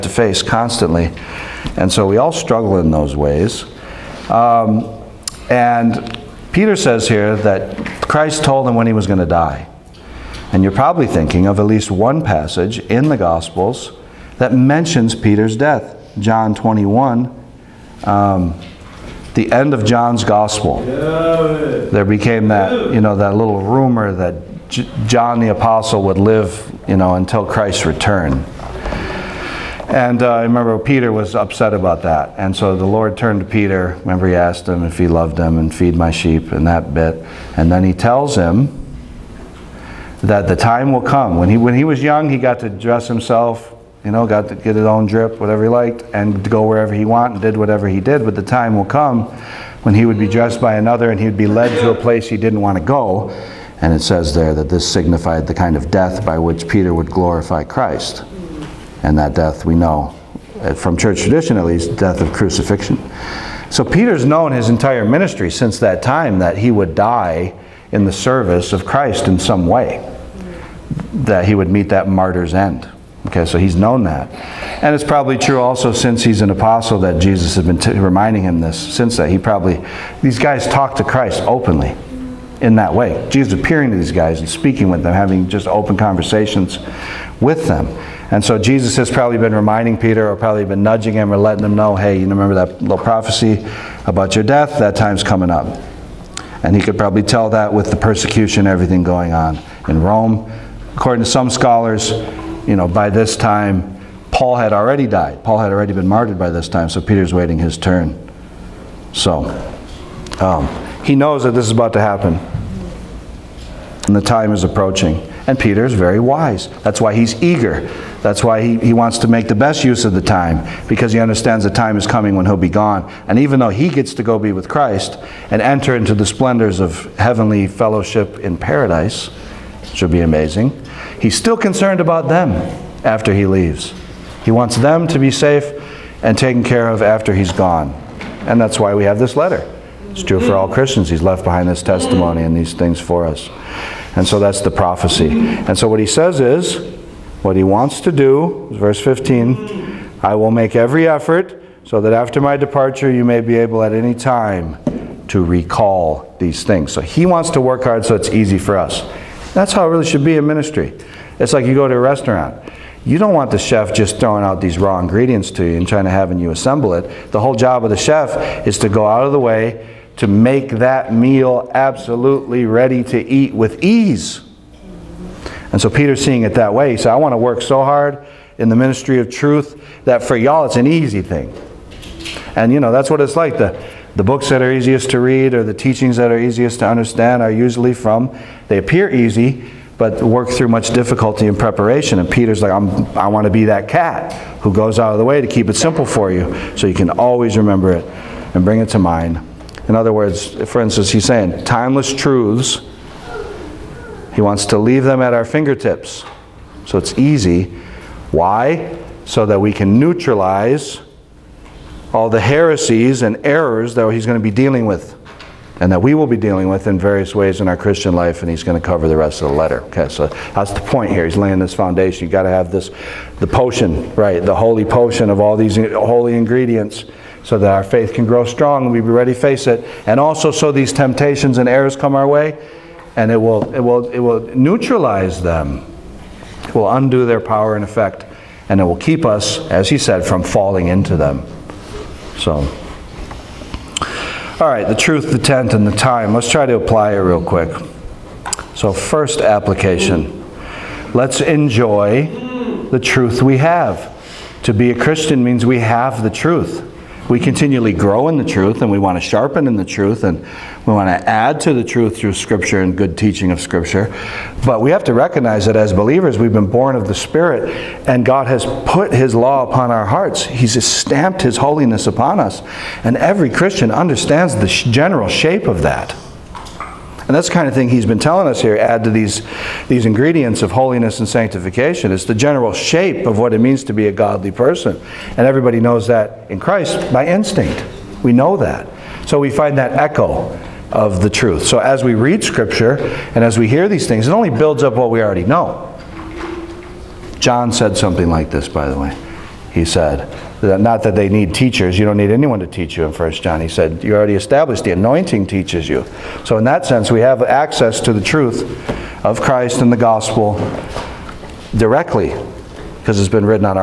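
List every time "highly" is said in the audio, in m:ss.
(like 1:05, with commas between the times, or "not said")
not said.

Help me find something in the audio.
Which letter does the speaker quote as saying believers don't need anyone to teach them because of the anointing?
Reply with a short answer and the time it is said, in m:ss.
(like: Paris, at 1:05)
First John, at 5:03.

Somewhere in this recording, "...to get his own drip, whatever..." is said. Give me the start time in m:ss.
0:44.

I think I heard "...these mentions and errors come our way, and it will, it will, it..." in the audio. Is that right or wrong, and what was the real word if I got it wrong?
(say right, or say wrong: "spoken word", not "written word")
wrong: "temptations", not "mentions".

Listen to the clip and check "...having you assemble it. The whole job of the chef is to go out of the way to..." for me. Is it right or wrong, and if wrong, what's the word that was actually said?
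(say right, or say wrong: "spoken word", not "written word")
right.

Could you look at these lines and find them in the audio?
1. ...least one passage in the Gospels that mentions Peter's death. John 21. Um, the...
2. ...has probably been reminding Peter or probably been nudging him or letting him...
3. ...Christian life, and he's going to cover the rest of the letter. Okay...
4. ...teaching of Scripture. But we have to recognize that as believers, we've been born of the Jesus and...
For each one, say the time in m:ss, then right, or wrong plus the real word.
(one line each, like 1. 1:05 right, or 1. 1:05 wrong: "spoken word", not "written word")
1. 0:11 right
2. 1:28 right
3. 3:37 right
4. 4:23 wrong: "Spirit", not "Jesus".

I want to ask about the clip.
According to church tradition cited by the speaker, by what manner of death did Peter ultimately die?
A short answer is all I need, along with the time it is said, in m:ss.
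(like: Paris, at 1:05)
Crucifixion, at 1:02.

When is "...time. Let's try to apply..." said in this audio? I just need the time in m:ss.
4:05.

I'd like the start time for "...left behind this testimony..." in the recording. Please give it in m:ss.
2:21.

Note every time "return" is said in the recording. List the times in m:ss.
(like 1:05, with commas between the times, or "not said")
0:27.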